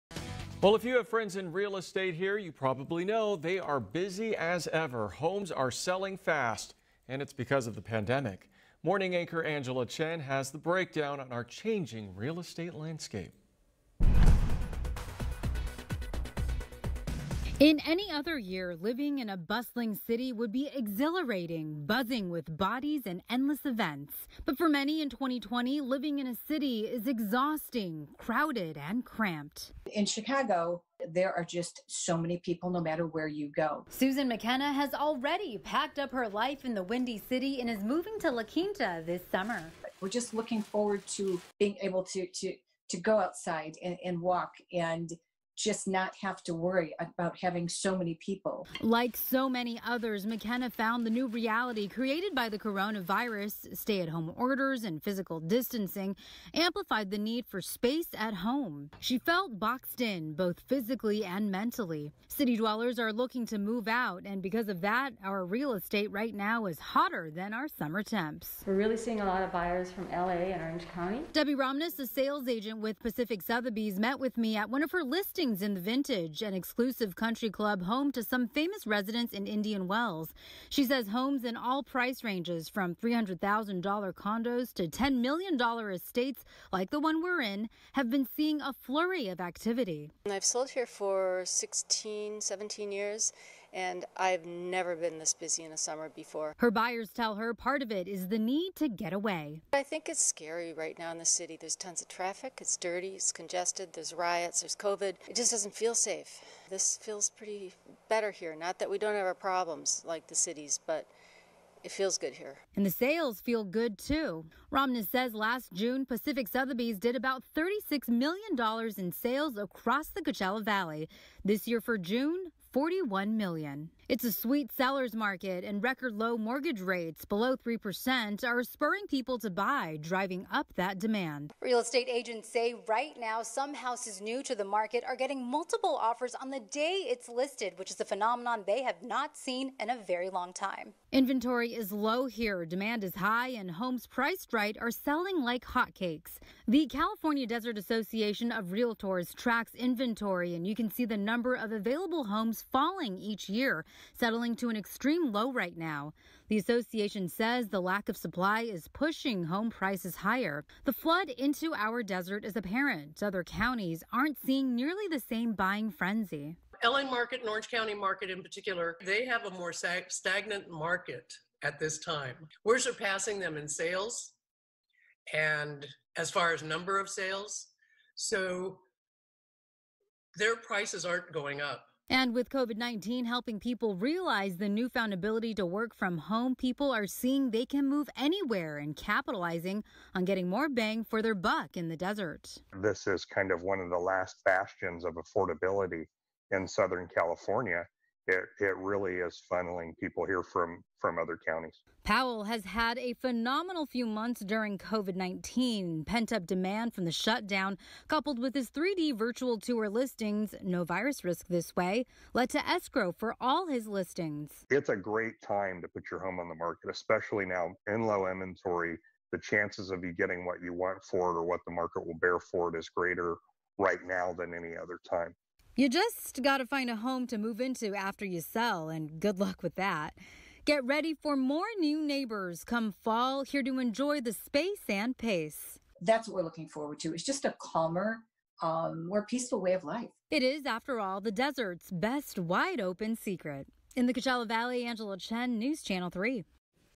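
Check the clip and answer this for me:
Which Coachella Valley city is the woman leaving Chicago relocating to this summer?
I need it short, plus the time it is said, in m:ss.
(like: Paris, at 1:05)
La Quinta, at 0:38.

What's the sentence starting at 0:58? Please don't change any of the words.
She felt boxed in, both physically and mentally.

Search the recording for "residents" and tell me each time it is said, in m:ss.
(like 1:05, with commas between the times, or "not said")
1:18.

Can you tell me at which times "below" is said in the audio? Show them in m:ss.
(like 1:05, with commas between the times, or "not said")
2:07.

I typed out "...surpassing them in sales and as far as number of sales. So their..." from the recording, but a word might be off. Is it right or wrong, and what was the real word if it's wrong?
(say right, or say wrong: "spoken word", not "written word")
right.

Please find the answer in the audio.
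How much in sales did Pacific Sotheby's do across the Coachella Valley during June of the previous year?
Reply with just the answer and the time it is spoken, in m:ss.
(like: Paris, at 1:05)
$36 million, at 1:57.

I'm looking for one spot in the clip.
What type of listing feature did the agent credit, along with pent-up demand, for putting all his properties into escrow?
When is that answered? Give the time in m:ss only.
3:28.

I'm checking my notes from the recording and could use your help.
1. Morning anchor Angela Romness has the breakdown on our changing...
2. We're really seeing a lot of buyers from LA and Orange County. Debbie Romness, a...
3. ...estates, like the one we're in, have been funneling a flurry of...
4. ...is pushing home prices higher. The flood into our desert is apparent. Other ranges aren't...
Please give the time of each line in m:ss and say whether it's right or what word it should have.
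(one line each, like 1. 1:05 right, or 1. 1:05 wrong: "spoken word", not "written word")
1. 0:08 wrong: "Chen", not "Romness"
2. 1:08 right
3. 1:25 wrong: "seeing", not "funneling"
4. 2:38 wrong: "counties", not "ranges".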